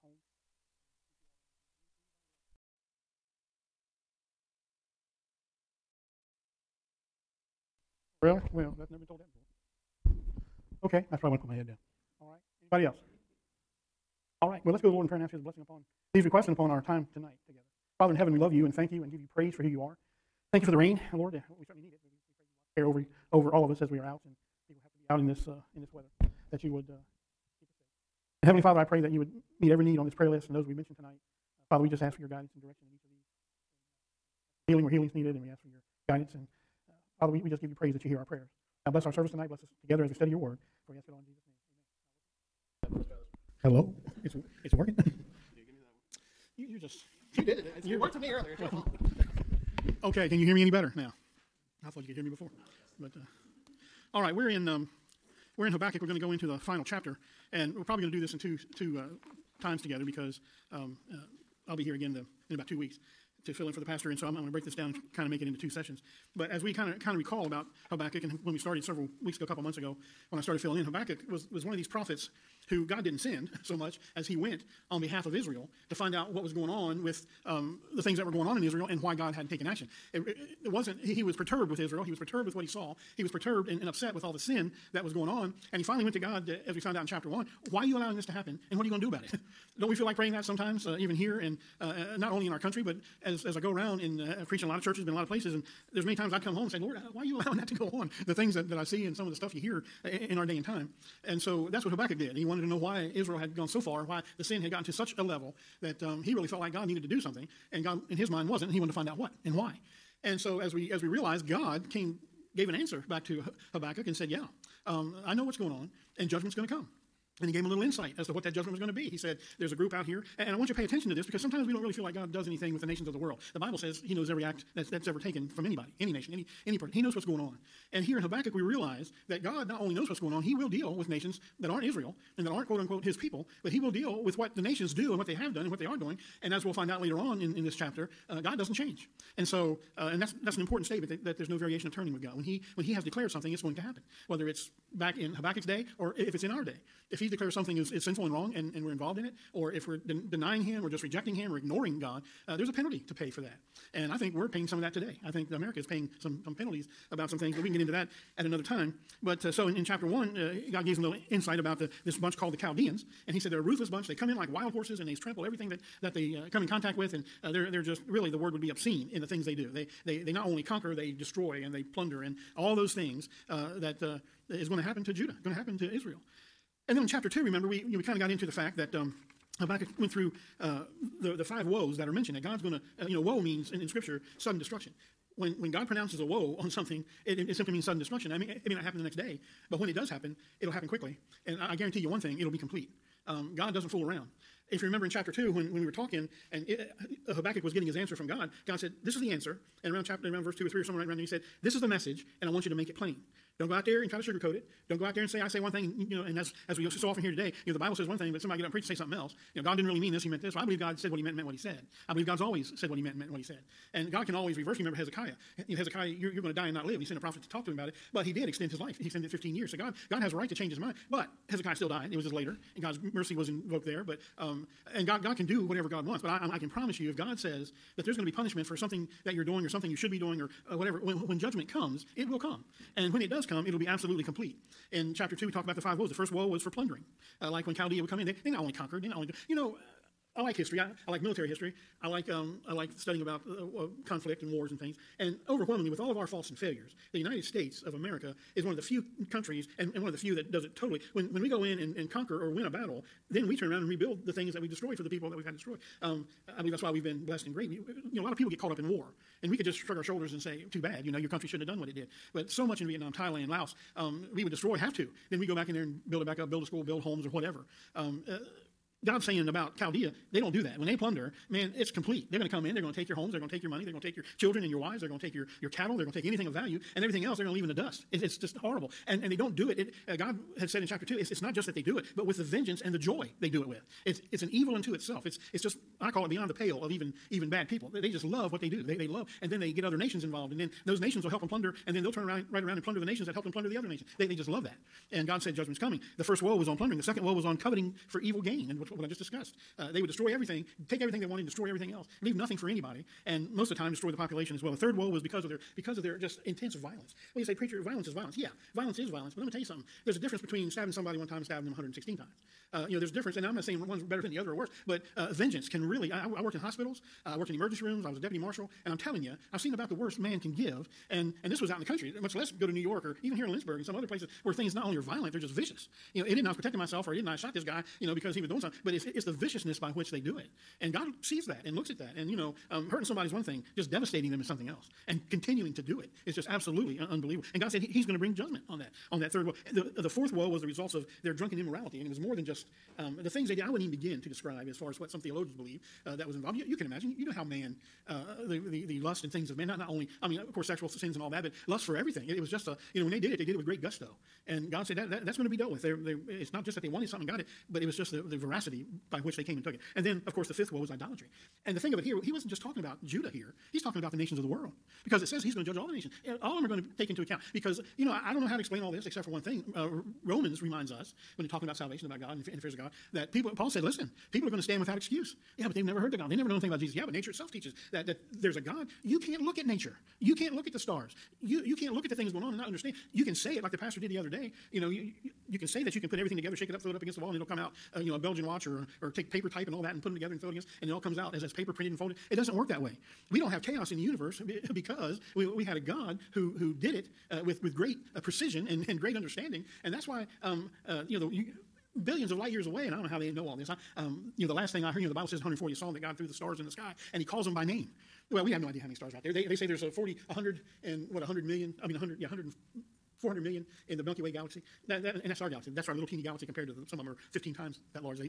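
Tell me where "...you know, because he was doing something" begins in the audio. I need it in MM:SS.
05:28.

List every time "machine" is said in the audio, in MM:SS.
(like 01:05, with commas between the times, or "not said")
not said.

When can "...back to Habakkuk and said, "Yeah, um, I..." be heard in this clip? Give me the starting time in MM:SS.
01:53.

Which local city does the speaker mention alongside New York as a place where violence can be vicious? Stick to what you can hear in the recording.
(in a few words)
Lynchburg.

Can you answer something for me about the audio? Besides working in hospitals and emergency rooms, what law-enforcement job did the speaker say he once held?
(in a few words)
deputy marshal.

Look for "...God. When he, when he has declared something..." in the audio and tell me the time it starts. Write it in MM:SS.
02:22.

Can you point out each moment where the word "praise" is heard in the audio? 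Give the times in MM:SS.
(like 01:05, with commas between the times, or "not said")
00:19, 00:37.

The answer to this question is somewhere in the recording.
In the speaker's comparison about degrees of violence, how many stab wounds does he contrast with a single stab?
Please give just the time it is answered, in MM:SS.
05:11.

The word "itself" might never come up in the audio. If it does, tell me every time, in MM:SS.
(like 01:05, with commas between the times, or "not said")
04:44, 06:17.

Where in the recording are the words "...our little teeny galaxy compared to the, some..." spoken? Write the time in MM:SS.
06:55.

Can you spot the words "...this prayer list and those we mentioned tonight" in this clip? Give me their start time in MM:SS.
00:30.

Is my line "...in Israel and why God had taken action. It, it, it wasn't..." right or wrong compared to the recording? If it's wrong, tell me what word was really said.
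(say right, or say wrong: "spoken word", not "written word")
right.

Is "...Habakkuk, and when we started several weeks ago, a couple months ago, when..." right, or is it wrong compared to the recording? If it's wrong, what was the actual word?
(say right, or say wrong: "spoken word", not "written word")
right.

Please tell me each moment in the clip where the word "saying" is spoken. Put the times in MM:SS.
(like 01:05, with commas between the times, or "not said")
04:29, 05:13.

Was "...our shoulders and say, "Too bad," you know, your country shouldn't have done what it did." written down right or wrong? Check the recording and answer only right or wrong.
right.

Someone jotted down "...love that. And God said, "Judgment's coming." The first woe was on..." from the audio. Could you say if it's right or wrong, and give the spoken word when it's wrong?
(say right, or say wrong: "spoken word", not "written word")
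right.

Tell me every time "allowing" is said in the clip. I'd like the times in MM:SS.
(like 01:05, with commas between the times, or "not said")
01:27, 01:37.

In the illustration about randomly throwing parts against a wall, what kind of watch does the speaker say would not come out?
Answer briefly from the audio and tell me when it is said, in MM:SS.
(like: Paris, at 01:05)
Belgian watch, at 06:28.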